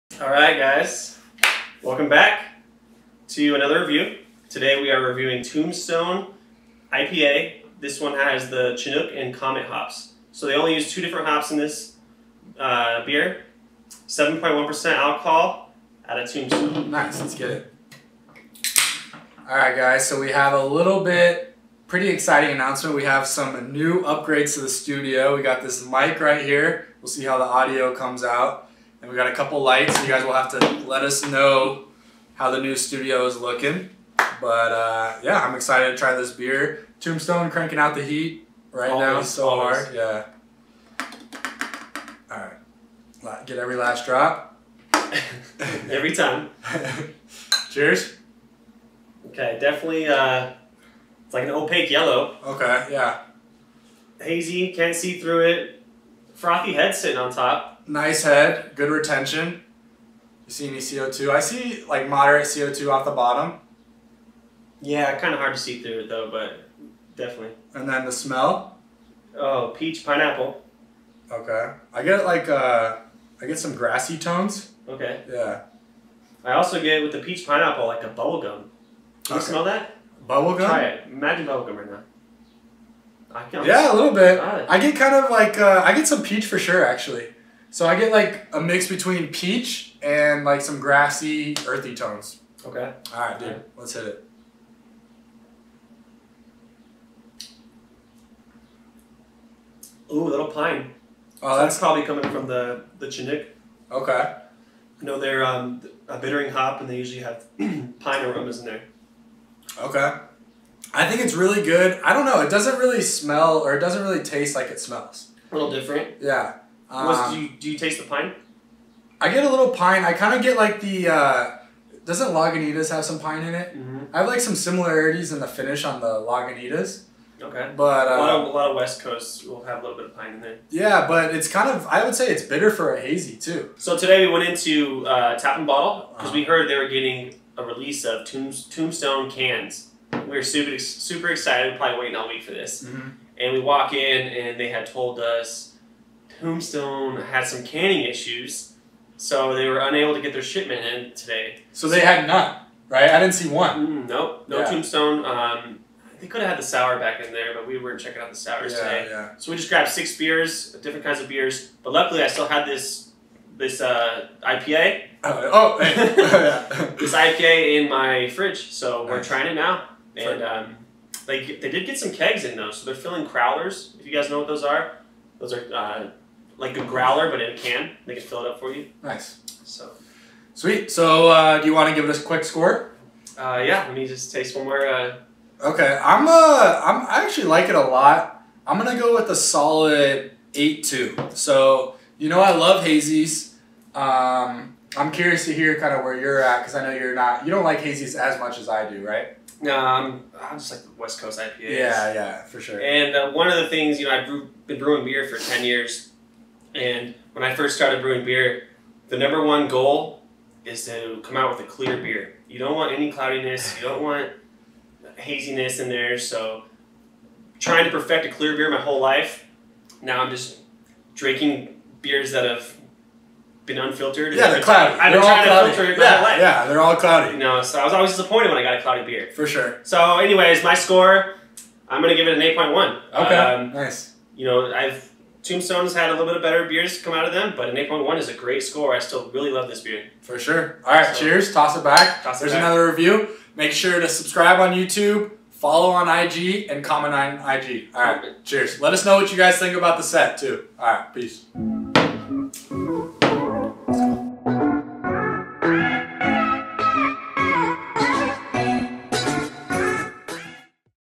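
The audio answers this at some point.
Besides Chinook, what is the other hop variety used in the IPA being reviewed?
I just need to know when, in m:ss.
0:09.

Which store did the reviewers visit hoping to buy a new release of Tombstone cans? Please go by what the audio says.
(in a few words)
Tap and Bottle.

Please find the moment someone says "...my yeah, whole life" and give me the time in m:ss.
3:45.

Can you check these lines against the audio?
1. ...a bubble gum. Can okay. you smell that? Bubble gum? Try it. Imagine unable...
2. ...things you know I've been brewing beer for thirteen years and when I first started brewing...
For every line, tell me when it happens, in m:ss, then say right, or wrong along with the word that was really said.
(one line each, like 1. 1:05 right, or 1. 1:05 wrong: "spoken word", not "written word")
1. 1:18 wrong: "bubble", not "unable"
2. 3:23 wrong: "ten", not "thirteen".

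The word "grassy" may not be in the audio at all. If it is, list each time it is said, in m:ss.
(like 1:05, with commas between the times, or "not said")
1:13, 1:30.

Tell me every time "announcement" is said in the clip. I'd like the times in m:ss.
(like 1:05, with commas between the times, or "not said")
0:22.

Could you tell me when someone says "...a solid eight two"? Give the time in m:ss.
3:09.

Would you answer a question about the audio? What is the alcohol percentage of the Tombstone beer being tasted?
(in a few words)
7.1%.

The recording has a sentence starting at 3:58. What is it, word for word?
I still really love this beer.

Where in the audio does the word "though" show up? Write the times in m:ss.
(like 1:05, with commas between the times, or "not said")
1:06, 2:52.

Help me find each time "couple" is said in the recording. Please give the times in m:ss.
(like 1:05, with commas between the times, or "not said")
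0:29.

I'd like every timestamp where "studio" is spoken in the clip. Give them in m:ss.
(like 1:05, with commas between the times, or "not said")
0:24, 0:32.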